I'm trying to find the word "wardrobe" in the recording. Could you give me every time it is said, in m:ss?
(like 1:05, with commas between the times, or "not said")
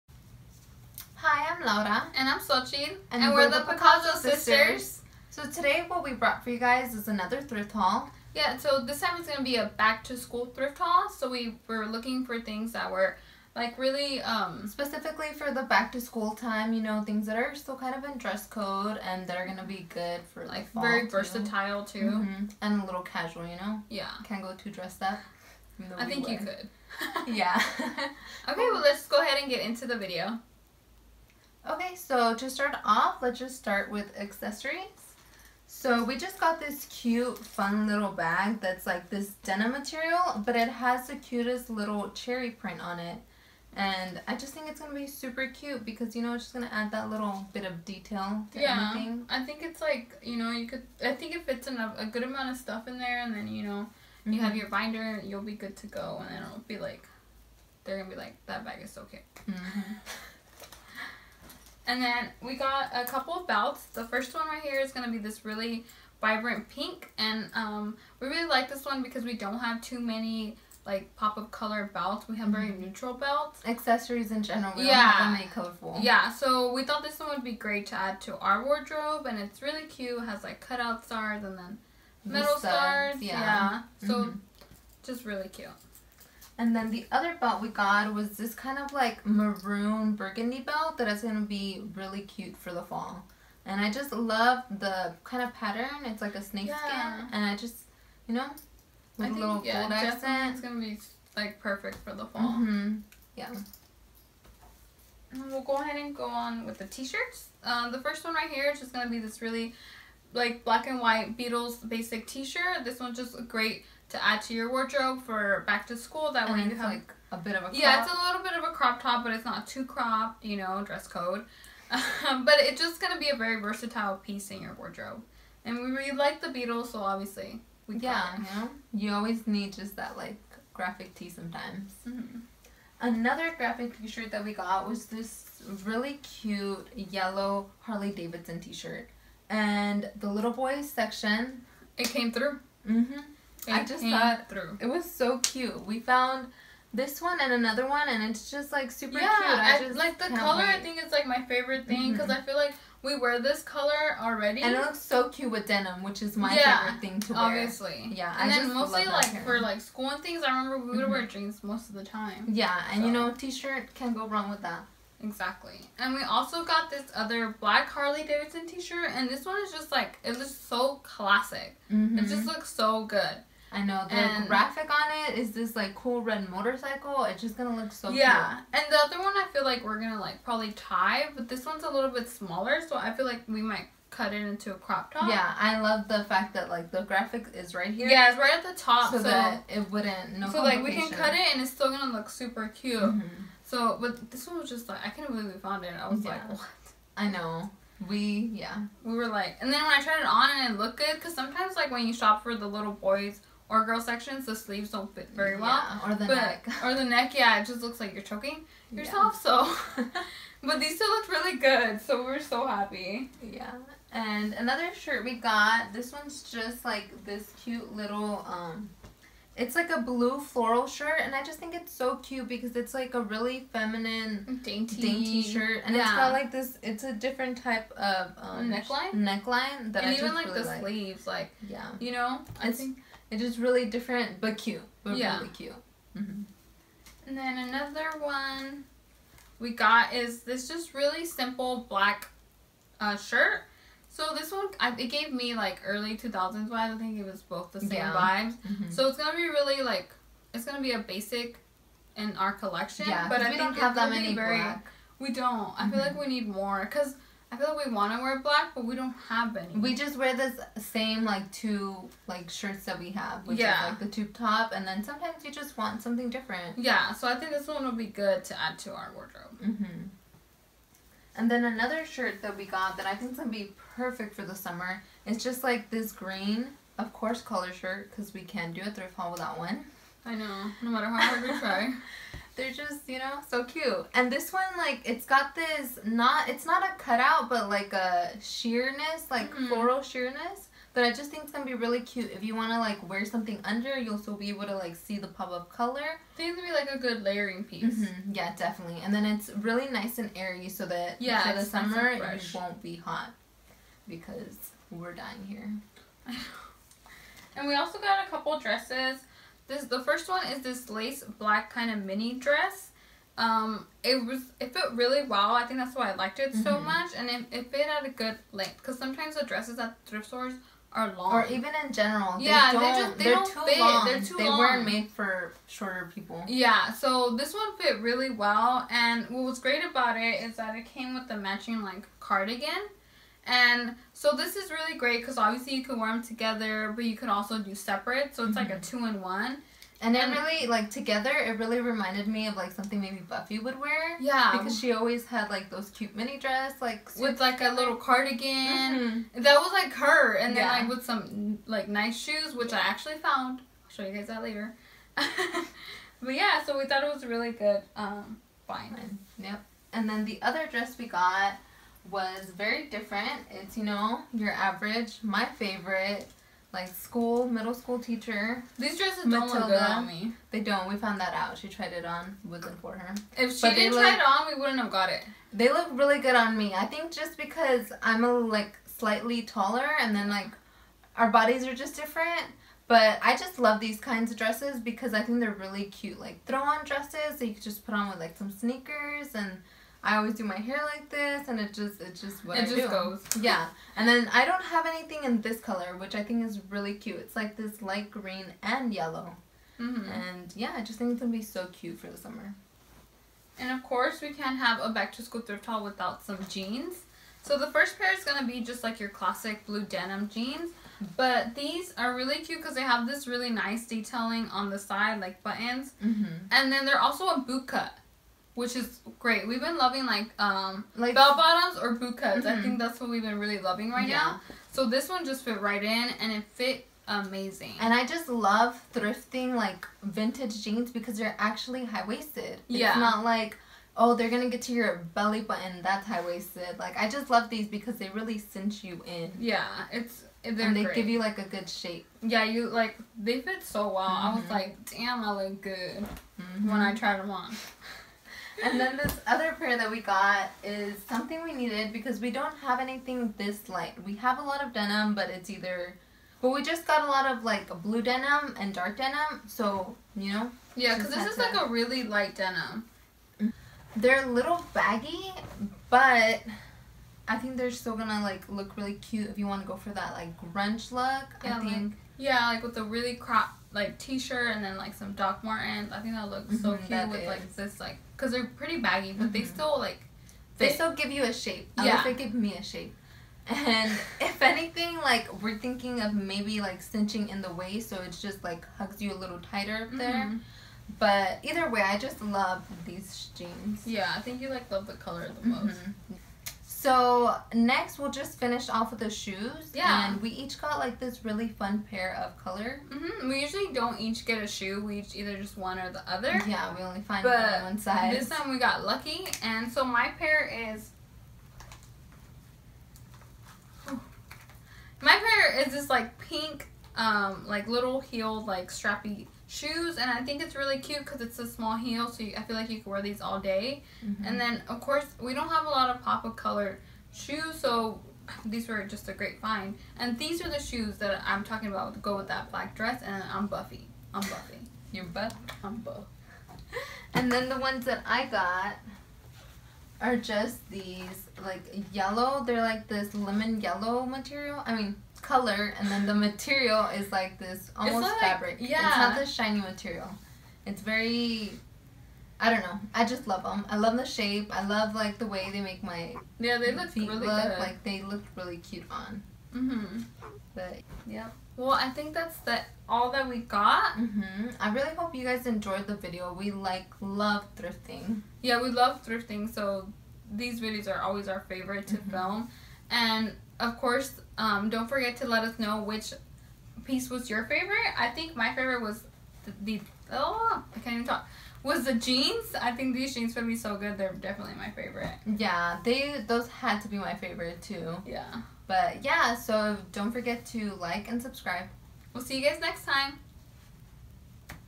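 1:18, 1:54, 2:04, 4:29.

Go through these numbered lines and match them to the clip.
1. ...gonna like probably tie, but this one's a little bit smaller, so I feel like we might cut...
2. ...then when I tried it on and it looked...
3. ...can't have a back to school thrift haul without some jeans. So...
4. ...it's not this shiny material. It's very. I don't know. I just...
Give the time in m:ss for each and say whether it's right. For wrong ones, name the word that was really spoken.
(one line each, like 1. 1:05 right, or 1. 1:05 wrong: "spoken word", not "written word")
1. 2:59 right
2. 3:19 right
3. 6:44 right
4. 9:08 right.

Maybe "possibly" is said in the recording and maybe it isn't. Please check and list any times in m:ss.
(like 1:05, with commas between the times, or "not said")
not said.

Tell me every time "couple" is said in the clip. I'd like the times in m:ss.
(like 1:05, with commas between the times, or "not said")
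1:03, 5:08.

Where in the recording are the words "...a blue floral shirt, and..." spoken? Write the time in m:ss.
3:39.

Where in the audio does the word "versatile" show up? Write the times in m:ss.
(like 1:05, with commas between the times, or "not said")
0:21, 2:03.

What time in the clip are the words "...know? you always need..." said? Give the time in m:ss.
2:08.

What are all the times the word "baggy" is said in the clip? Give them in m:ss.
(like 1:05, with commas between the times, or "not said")
7:44, 7:58.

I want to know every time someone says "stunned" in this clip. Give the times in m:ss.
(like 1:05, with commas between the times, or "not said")
not said.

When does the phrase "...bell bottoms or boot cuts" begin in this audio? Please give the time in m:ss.
7:01.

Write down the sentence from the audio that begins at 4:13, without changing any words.
Yeah, but I we think don't have that many very, black.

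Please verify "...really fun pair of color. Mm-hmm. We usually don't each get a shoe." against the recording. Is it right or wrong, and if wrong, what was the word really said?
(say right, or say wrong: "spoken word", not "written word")
right.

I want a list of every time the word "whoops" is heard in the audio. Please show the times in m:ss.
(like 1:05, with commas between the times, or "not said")
not said.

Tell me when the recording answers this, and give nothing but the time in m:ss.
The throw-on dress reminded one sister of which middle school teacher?
6:09.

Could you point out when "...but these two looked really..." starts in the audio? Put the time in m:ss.
3:30.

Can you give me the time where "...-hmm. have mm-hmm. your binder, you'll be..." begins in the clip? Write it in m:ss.
0:54.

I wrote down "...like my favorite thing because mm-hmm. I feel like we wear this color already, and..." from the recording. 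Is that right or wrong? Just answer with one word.
right.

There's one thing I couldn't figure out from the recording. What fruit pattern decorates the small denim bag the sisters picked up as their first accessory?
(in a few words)
Cherry.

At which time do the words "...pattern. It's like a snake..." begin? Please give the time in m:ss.
1:35.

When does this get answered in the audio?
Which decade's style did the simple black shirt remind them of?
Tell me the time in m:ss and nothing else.
4:05.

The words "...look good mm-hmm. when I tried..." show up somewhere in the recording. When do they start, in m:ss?
7:25.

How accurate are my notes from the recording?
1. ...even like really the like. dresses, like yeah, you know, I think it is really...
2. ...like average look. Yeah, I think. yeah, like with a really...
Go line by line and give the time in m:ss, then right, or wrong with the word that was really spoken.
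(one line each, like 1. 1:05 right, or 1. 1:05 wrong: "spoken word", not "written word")
1. 3:50 wrong: "sleeves", not "dresses"
2. 7:50 wrong: "grunge", not "average".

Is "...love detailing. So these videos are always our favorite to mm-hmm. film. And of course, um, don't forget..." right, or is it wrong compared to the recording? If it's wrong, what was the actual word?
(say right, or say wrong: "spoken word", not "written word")
wrong: "thrifting", not "detailing".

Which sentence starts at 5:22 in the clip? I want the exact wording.
Yeah, they, don't, they just they are don't too fit.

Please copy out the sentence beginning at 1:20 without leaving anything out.
It has like cutout stars and then metal stars.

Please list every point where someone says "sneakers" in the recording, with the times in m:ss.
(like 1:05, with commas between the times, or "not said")
6:28.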